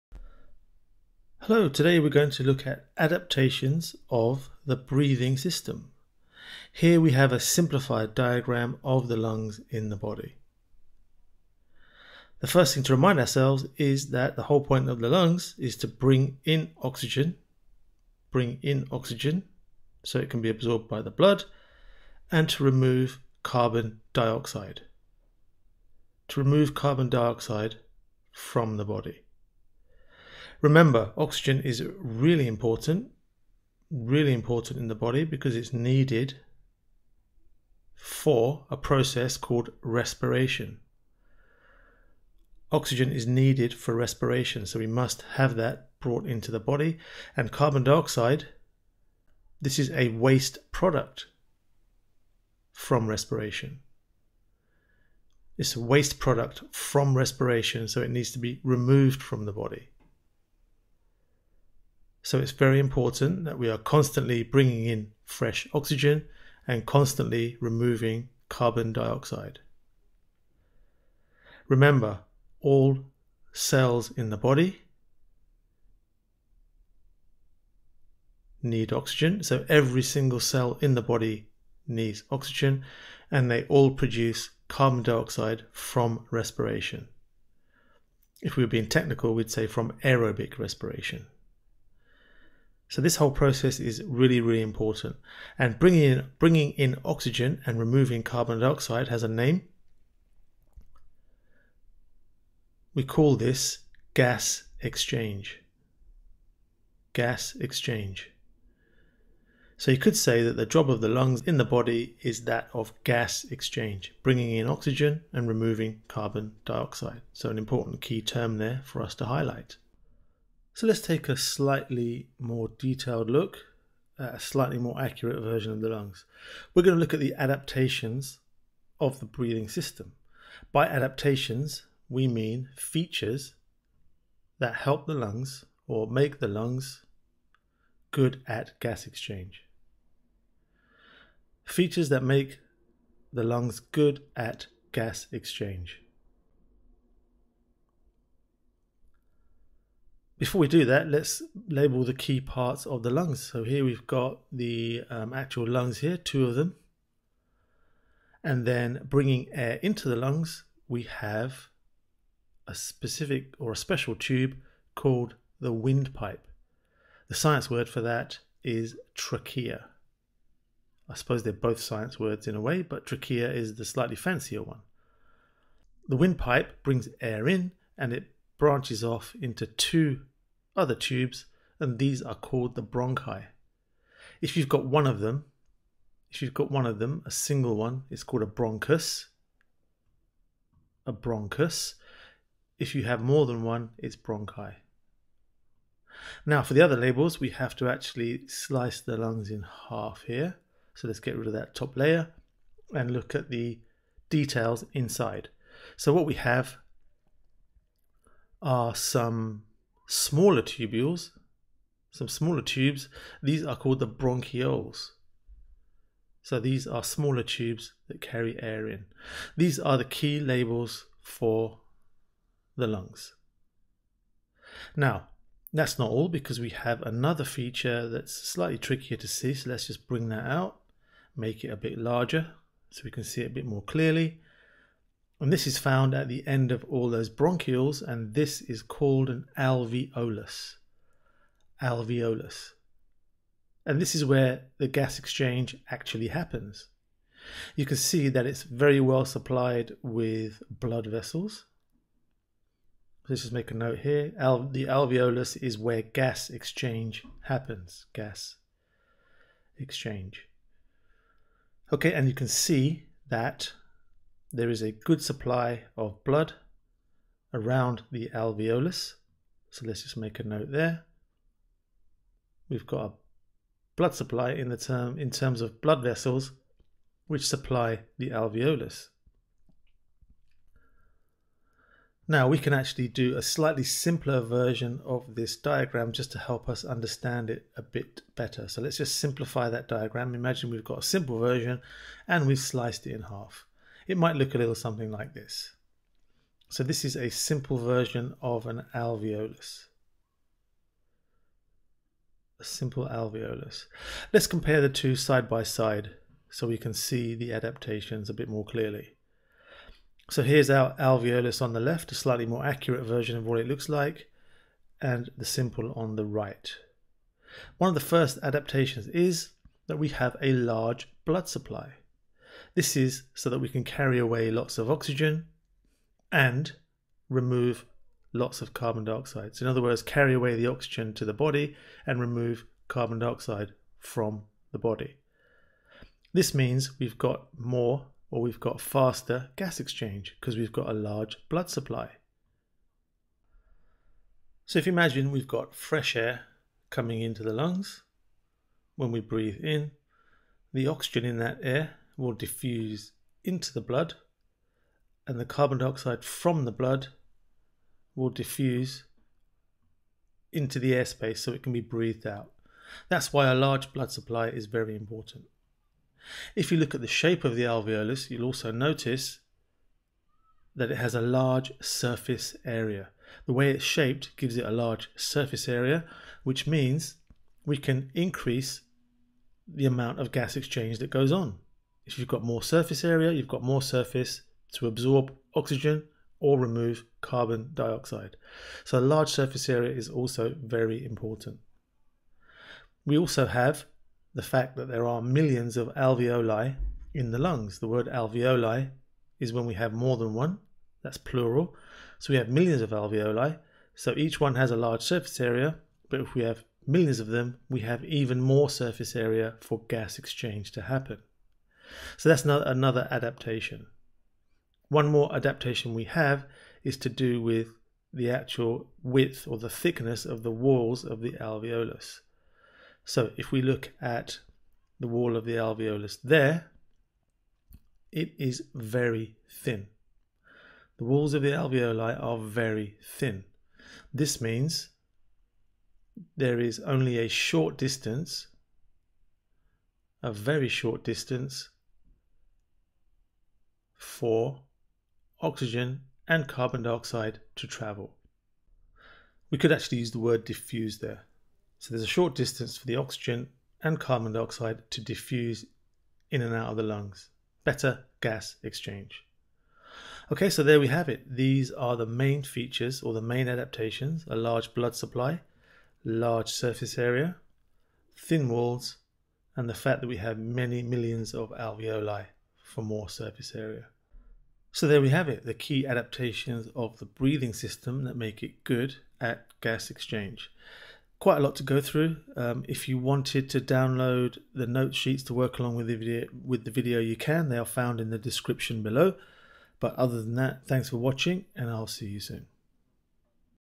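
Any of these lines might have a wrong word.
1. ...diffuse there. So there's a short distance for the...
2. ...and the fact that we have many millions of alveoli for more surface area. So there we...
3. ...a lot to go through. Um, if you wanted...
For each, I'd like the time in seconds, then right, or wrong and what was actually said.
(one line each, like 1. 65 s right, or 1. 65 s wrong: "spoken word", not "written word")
1. 450 s right
2. 469 s right
3. 481 s right.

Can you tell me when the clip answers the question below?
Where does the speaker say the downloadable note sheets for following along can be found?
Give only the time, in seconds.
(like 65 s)
487 s.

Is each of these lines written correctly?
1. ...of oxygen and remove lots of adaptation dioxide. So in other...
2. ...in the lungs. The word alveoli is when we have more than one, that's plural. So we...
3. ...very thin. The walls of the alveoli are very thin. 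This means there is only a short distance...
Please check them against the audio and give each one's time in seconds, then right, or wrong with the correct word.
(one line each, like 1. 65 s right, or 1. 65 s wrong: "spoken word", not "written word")
1. 324 s wrong: "carbon", not "adaptation"
2. 397 s right
3. 428 s right.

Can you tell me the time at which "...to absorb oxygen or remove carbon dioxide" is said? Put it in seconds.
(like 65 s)
384 s.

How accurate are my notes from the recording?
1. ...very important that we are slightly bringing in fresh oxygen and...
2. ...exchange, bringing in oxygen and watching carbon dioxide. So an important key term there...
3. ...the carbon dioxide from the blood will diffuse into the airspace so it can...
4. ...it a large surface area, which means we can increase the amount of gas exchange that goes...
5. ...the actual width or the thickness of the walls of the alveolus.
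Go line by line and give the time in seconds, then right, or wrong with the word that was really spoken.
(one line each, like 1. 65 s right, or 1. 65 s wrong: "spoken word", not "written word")
1. 62 s wrong: "constantly", not "slightly"
2. 113 s wrong: "removing", not "watching"
3. 355 s right
4. 374 s right
5. 418 s right.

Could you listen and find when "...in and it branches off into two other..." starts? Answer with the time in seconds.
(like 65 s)
177 s.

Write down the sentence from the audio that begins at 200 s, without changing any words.
So let's get rid of that top layer and look at the details inside.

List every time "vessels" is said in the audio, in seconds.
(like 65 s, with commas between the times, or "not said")
251 s, 276 s.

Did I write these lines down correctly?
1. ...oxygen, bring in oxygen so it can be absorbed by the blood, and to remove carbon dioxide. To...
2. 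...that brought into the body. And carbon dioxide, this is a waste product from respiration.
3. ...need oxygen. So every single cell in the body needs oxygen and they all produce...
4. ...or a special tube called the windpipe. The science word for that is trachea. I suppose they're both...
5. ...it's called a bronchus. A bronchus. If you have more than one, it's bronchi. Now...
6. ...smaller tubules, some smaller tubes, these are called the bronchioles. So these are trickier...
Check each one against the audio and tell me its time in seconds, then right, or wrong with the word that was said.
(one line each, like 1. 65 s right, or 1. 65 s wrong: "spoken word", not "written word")
1. 16 s right
2. 45 s right
3. 78 s right
4. 163 s right
5. 188 s right
6. 210 s wrong: "smaller", not "trickier".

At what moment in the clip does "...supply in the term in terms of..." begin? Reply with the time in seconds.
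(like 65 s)
274 s.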